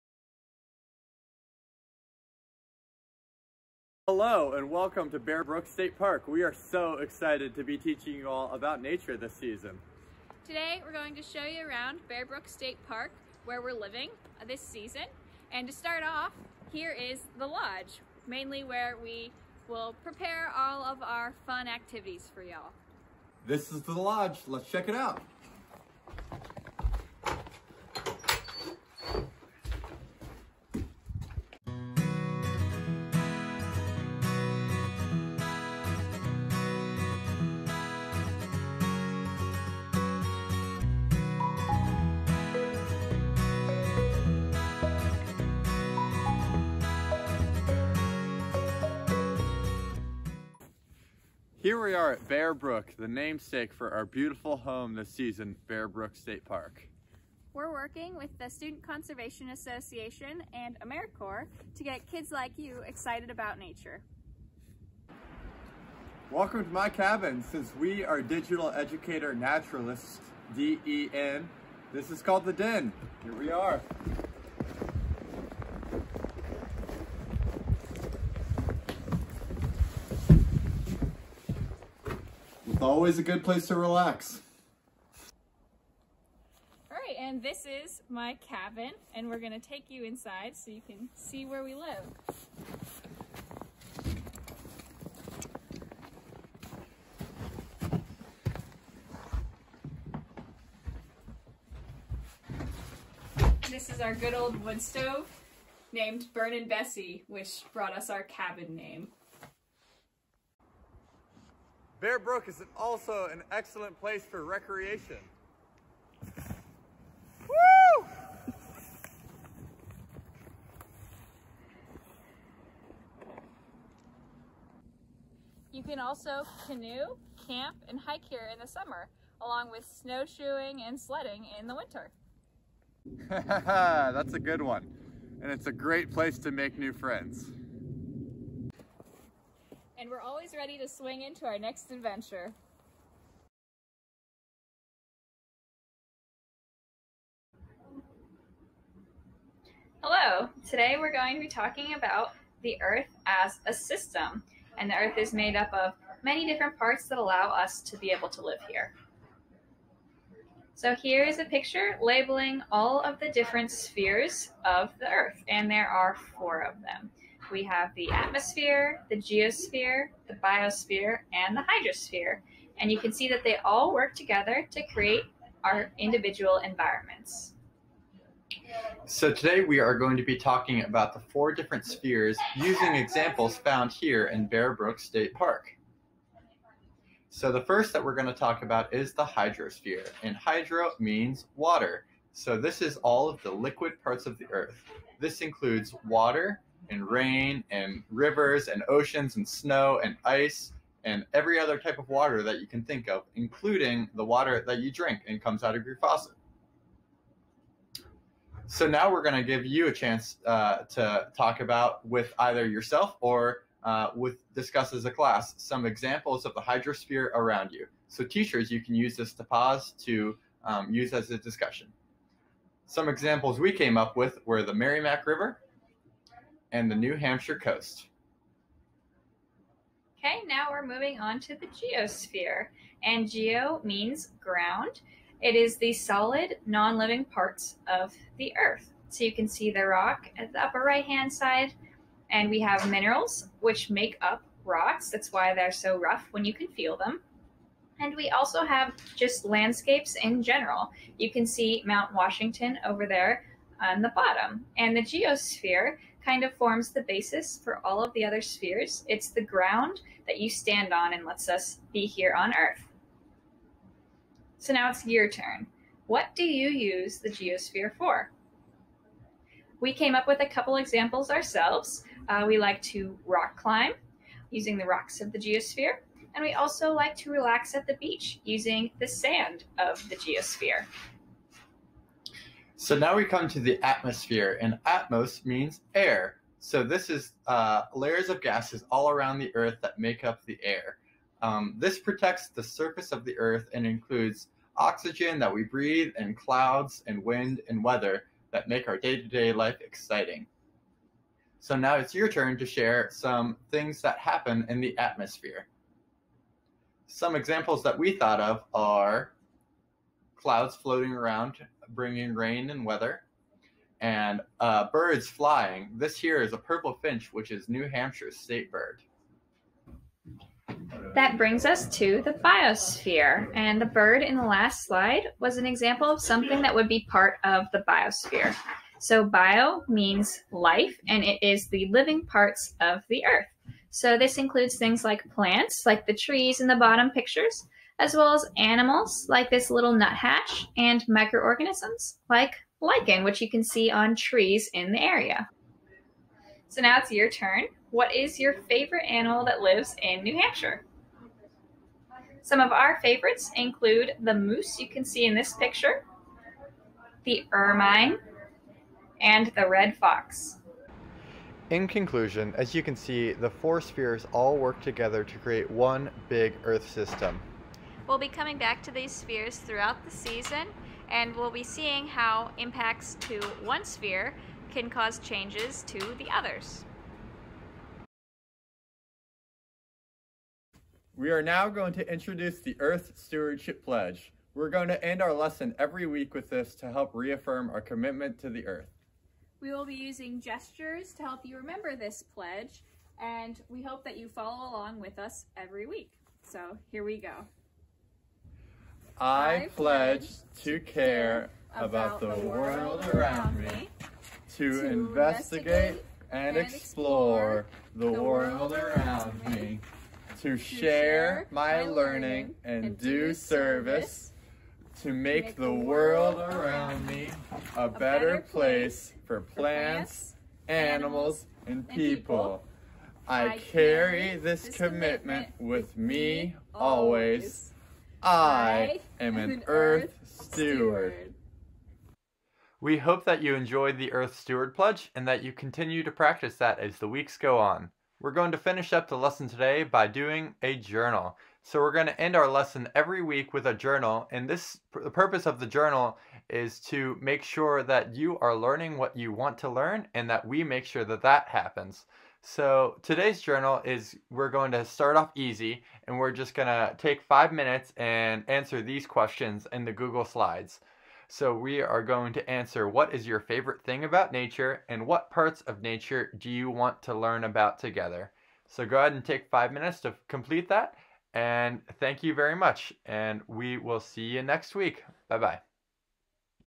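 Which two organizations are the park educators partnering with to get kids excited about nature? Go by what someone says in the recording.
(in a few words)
Student Conservation Association and AmeriCorps.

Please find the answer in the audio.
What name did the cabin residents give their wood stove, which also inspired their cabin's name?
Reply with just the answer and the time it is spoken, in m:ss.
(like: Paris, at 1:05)
Burn and Bessie, at 1:46.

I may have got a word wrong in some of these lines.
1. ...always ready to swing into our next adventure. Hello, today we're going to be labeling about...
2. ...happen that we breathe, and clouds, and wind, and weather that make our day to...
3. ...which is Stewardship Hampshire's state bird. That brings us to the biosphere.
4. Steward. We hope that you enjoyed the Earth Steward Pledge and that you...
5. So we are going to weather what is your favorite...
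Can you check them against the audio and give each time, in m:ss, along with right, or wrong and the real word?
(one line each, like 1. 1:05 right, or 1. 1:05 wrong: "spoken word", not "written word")
1. 2:20 wrong: "talking", not "labeling"
2. 4:54 wrong: "oxygen", not "happen"
3. 5:17 wrong: "New", not "Stewardship"
4. 7:11 right
5. 7:41 wrong: "answer", not "weather".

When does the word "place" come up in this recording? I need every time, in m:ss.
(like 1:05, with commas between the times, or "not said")
1:23, 1:53, 2:16, 6:58.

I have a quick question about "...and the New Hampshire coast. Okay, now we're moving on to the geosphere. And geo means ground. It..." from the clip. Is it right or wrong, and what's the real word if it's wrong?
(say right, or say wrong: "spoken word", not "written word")
right.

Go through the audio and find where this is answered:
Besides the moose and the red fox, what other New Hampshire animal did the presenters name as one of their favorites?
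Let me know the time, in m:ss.
5:57.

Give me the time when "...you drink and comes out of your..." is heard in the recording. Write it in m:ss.
3:24.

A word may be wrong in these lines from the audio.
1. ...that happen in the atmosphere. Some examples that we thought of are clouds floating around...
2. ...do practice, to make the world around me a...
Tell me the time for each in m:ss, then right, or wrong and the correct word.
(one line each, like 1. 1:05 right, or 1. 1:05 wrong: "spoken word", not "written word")
1. 5:04 right
2. 6:52 wrong: "service", not "practice".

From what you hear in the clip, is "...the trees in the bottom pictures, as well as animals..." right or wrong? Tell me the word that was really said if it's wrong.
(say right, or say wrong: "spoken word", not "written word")
right.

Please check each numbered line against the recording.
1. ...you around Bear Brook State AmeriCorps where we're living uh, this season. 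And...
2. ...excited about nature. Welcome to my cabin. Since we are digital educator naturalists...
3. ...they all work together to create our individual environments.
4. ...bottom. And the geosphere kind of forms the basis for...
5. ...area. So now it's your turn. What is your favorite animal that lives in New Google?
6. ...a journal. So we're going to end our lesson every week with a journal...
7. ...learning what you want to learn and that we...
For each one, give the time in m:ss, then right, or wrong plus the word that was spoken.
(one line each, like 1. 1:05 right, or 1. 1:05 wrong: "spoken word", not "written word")
1. 0:11 wrong: "Park", not "AmeriCorps"
2. 1:02 right
3. 2:53 right
4. 4:14 right
5. 5:44 wrong: "Hampshire", not "Google"
6. 7:20 right
7. 7:28 right.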